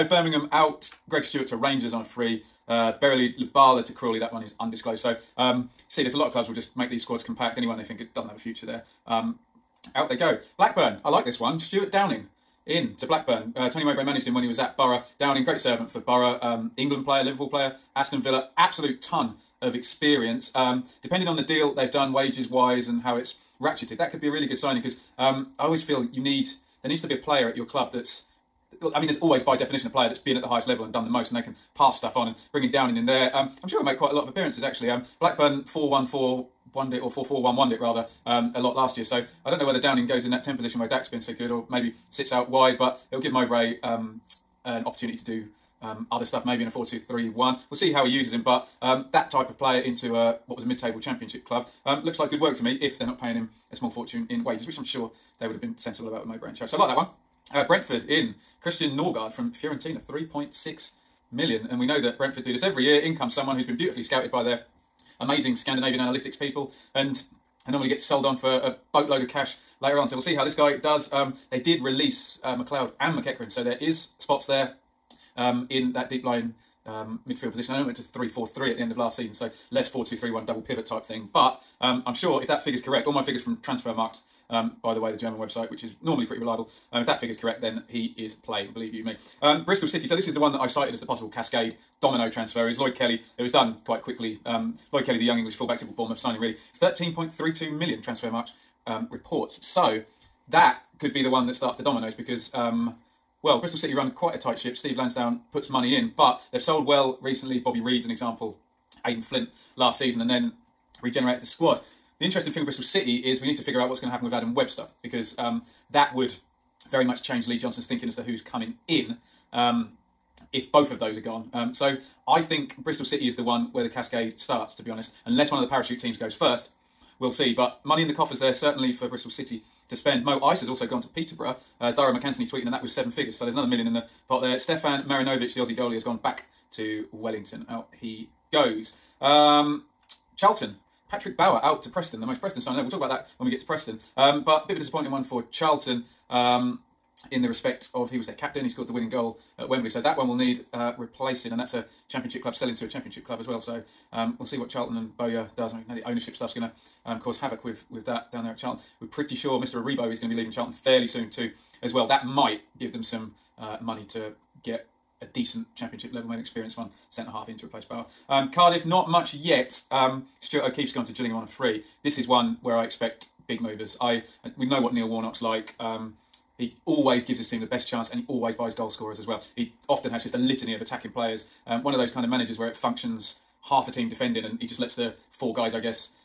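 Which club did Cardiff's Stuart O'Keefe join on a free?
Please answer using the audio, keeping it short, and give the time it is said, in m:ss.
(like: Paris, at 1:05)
Gillingham, at 2:51.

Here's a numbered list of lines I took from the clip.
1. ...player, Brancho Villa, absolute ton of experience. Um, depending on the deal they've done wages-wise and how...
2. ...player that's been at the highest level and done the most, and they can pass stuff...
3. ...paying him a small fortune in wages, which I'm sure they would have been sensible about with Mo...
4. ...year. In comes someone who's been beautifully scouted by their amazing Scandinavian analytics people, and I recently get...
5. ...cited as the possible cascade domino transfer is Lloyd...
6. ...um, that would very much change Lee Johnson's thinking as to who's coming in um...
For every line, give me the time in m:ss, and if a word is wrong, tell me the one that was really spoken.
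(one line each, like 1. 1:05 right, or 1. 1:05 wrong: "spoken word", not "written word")
1. 0:17 wrong: "Aston", not "Brancho"
2. 0:29 right
3. 0:53 right
4. 1:02 wrong: "normally", not "recently"
5. 1:30 right
6. 1:55 right.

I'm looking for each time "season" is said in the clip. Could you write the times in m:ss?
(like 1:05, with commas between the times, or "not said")
1:19, 1:49.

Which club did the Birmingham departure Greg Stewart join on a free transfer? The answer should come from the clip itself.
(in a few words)
Rangers.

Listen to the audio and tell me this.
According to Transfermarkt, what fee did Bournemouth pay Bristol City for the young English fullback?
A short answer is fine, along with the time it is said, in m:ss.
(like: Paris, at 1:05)
13.32 million, at 1:36.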